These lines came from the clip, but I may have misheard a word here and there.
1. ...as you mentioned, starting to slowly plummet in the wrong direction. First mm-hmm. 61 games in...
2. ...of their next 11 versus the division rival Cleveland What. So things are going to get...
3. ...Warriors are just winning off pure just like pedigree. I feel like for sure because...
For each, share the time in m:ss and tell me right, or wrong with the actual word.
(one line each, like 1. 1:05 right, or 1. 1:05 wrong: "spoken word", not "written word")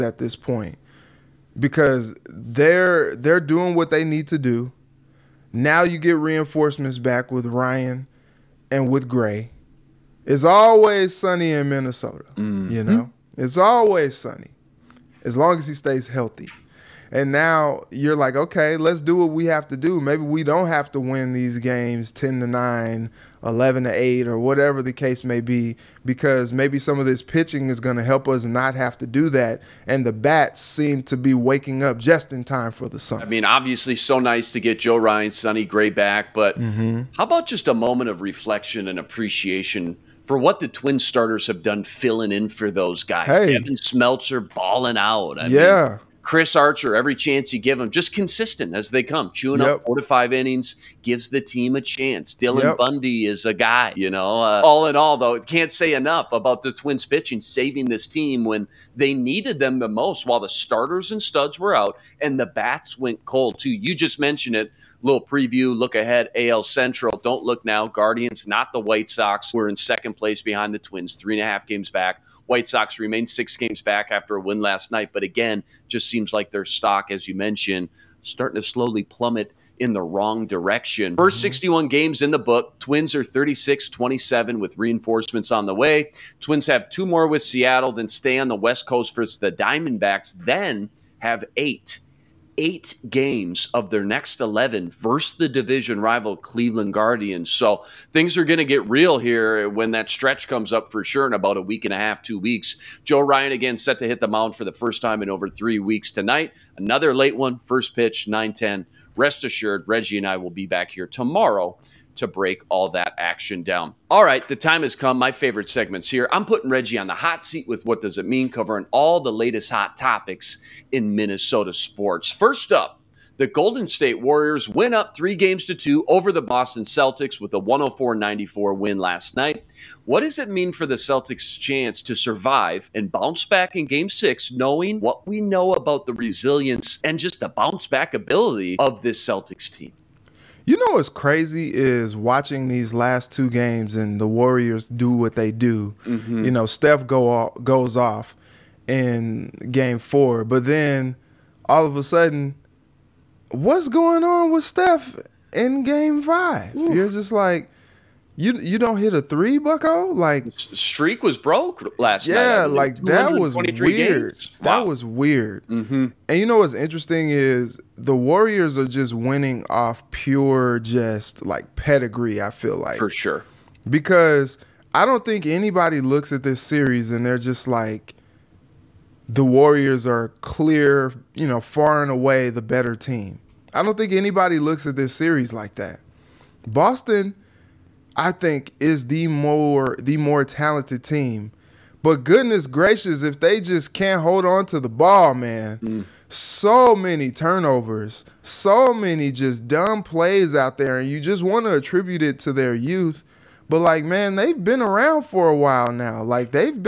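1. 1:17 right
2. 1:33 wrong: "Guardians", not "What"
3. 2:48 right.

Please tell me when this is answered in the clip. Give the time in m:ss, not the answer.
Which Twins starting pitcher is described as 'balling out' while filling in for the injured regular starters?
0:43.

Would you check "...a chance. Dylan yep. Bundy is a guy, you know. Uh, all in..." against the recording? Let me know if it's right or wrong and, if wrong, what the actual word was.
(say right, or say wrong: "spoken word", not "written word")
right.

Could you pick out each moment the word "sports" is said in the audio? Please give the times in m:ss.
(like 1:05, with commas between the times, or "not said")
2:01.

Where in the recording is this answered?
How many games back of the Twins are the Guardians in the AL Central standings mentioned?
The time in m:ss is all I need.
1:11.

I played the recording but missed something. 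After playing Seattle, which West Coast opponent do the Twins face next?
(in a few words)
Diamondbacks.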